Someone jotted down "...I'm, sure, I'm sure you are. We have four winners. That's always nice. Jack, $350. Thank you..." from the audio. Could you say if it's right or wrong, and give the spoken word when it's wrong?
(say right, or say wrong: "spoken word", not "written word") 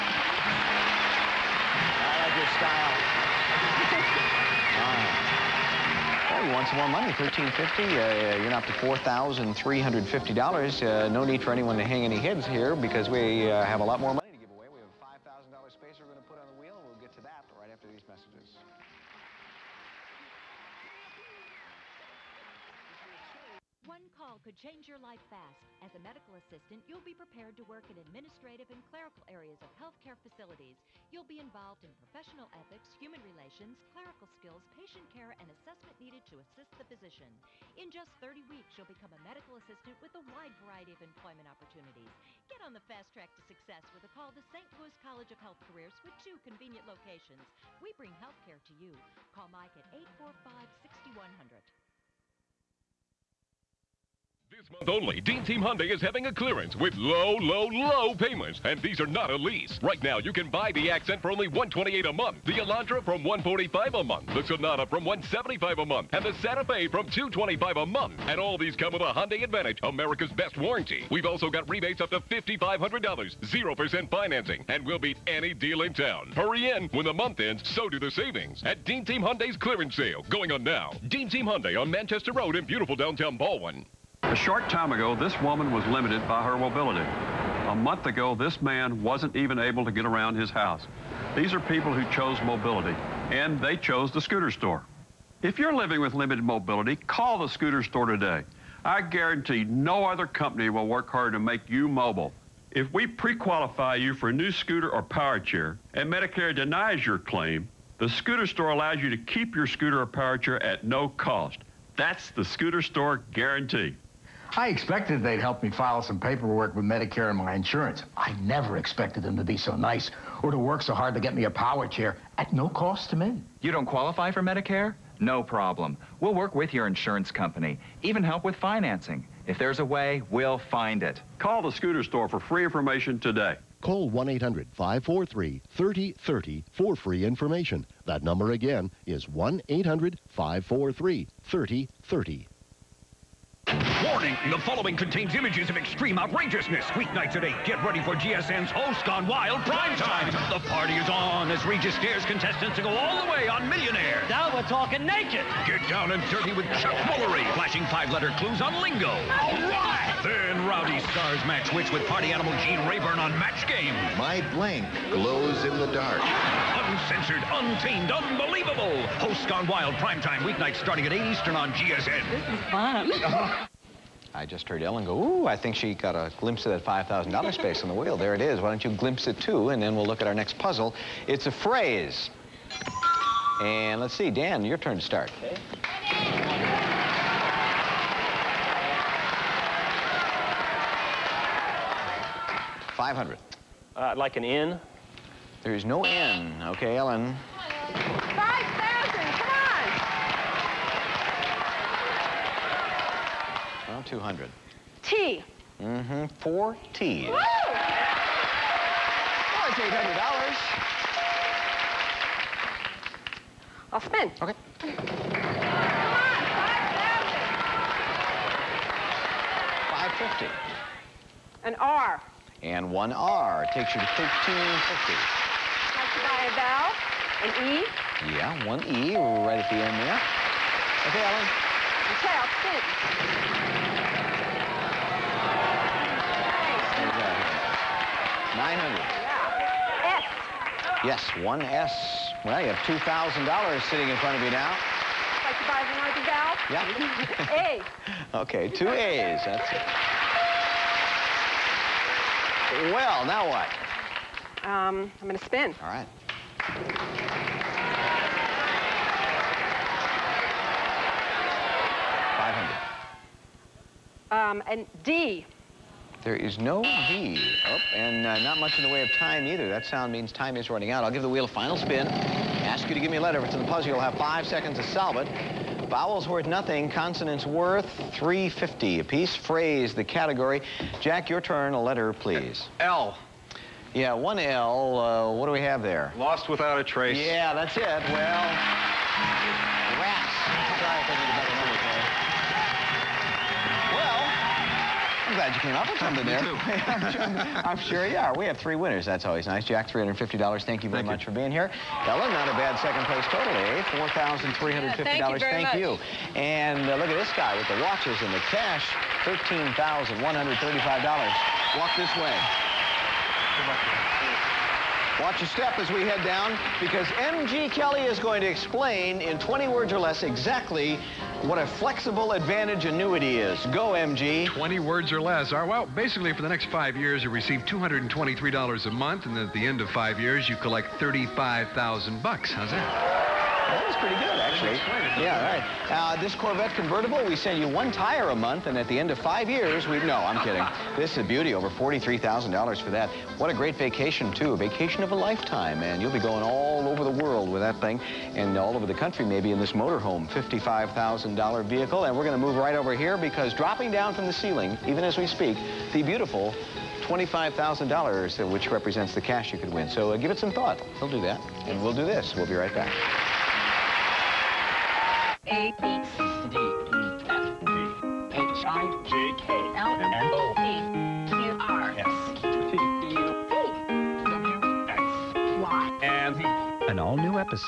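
wrong: "three", not "four".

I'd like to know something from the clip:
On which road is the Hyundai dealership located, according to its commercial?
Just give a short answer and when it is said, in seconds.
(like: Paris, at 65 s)
Manchester Road, at 81 s.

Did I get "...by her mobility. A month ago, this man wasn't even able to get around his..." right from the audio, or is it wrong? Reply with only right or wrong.
right.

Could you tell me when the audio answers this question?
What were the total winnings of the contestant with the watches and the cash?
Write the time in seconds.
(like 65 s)
309 s.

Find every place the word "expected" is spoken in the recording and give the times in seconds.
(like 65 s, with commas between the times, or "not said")
114 s, 118 s.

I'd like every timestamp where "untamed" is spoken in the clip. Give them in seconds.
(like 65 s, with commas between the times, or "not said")
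167 s.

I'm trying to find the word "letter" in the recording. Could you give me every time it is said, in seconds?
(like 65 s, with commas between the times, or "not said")
157 s, 273 s, 281 s.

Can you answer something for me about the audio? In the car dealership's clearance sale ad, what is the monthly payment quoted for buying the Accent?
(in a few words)
$128.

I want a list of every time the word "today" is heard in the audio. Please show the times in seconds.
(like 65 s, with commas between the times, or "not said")
98 s, 133 s.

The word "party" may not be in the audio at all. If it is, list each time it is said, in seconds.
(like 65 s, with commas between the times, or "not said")
150 s, 162 s.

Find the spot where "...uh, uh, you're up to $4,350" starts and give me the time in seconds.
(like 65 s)
7 s.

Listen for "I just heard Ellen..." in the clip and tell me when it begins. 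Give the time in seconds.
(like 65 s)
174 s.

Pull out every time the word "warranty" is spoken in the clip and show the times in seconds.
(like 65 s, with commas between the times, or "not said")
70 s.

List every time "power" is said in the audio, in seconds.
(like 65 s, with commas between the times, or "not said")
105 s, 110 s, 121 s.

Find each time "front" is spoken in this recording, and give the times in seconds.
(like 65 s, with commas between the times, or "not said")
244 s.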